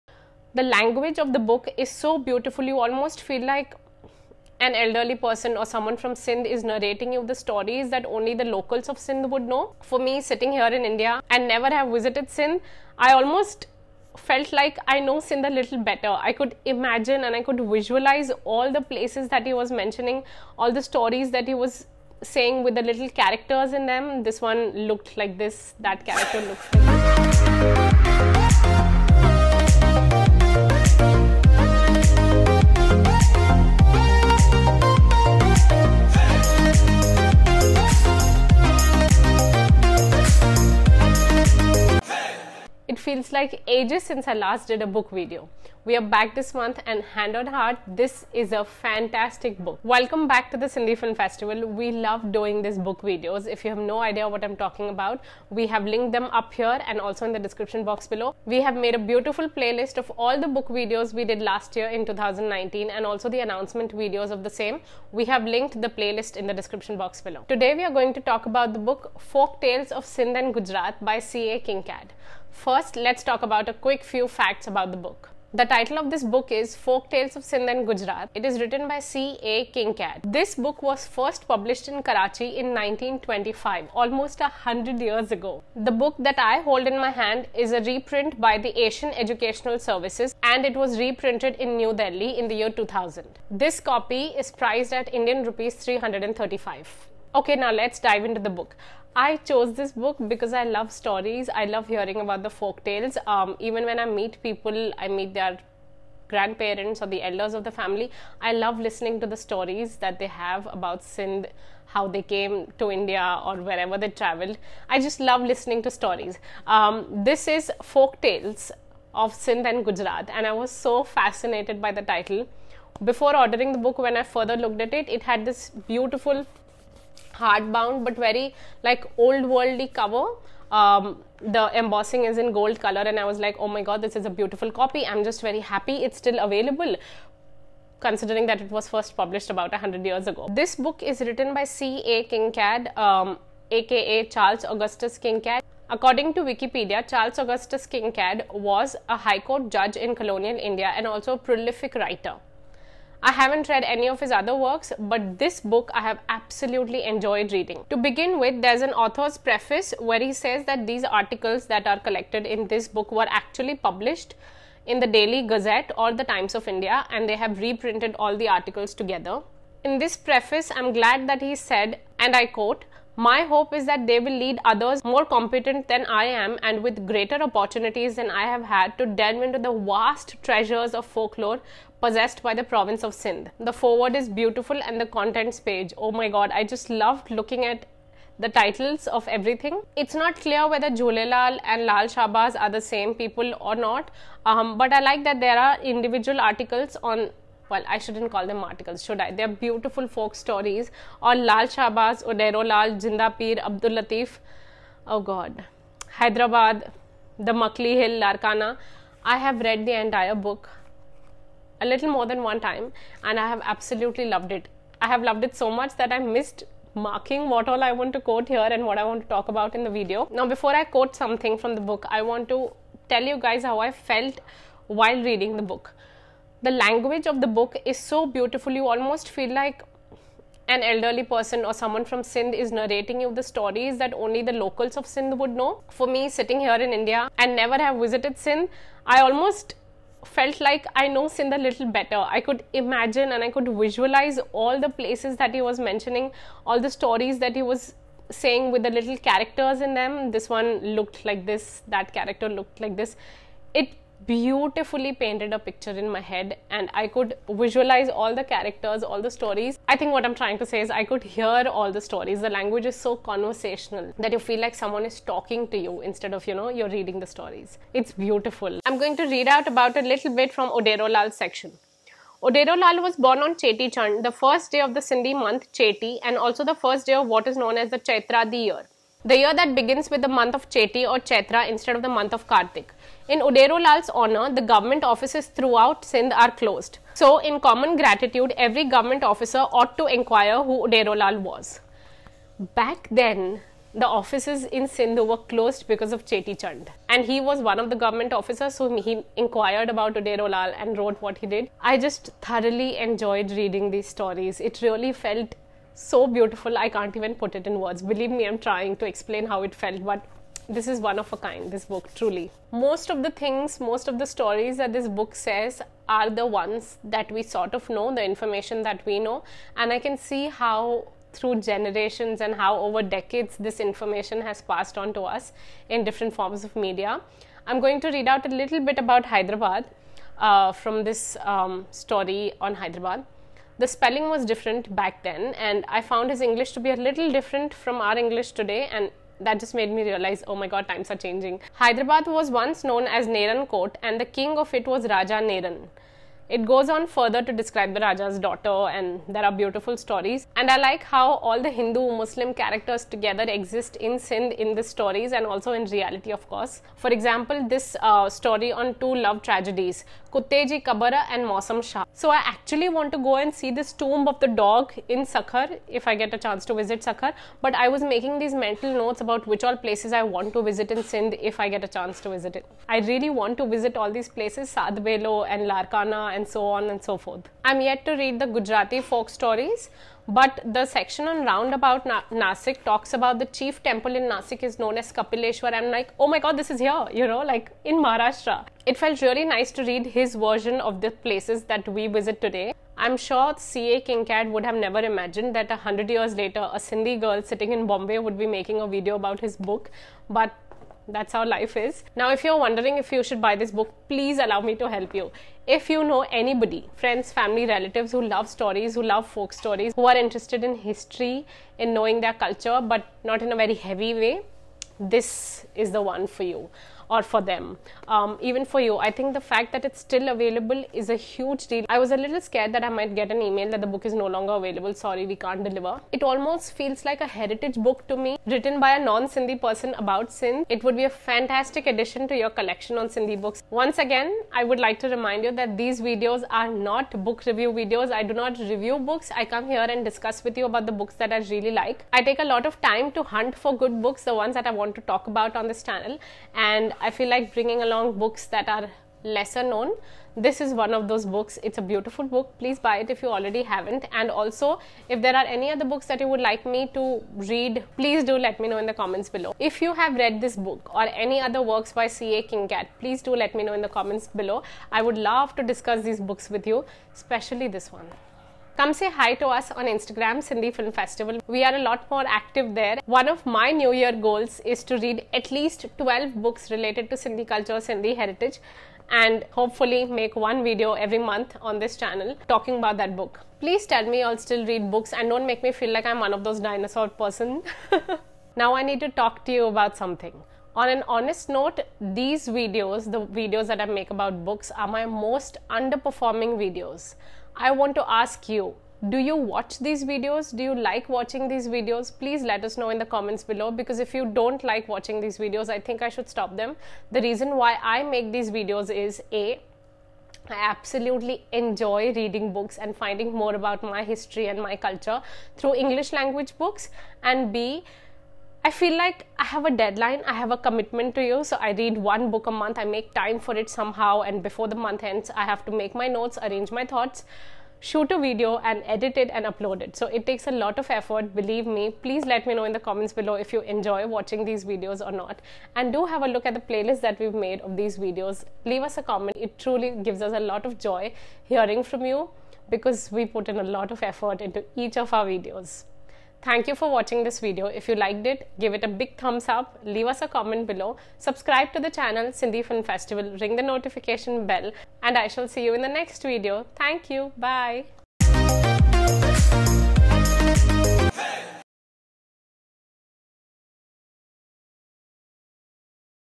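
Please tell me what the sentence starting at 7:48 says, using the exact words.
Come say hi to us on Instagram, Sindhi Film Festival.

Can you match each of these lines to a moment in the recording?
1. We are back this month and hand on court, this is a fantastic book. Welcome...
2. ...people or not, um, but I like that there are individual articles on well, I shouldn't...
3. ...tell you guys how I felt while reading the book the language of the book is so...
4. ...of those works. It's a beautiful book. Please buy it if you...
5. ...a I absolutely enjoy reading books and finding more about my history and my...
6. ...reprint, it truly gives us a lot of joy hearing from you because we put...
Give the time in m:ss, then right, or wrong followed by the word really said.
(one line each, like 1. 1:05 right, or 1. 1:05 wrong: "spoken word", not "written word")
1. 0:45 wrong: "heart", not "court"
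2. 3:13 right
3. 3:43 right
4. 7:30 wrong: "books", not "works"
5. 8:29 right
6. 8:59 wrong: "comment", not "reprint".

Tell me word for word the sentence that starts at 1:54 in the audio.
I just love listening to stories.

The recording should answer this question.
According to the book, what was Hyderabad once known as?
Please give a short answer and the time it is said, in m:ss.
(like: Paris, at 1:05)
Neran Court, at 5:43.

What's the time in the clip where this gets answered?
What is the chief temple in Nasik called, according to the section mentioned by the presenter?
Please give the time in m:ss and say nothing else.
6:25.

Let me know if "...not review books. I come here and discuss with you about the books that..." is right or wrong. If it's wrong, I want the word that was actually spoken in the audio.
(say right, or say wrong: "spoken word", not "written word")
right.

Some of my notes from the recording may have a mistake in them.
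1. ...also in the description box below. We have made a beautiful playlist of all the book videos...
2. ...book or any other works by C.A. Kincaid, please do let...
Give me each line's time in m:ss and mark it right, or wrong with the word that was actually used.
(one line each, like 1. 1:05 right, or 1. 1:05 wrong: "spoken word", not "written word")
1. 0:56 right
2. 7:40 right.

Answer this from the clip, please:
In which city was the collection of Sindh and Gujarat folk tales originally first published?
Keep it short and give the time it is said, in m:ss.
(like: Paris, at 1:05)
Karachi, at 1:22.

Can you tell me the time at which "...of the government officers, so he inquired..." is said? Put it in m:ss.
4:57.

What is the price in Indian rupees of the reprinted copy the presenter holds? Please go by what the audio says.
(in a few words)
335.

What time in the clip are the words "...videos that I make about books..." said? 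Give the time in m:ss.
8:13.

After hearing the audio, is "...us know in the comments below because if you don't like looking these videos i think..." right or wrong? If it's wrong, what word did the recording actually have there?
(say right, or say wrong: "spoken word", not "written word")
wrong: "watching", not "looking".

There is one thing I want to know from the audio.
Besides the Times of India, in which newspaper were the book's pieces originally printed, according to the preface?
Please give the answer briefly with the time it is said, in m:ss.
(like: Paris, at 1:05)
Daily Gazette, at 2:45.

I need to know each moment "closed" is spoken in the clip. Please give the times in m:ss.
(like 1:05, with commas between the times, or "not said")
4:46, 4:55.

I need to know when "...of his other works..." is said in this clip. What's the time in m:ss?
2:34.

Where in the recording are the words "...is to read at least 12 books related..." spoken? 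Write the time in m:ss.
7:54.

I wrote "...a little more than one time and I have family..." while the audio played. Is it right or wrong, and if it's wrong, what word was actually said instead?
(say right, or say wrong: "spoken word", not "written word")
wrong: "absolutely", not "family".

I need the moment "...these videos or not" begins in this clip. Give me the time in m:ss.
8:54.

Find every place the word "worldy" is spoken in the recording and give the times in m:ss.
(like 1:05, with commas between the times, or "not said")
2:09.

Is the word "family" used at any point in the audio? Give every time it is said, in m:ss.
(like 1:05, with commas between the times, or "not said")
1:47, 6:47.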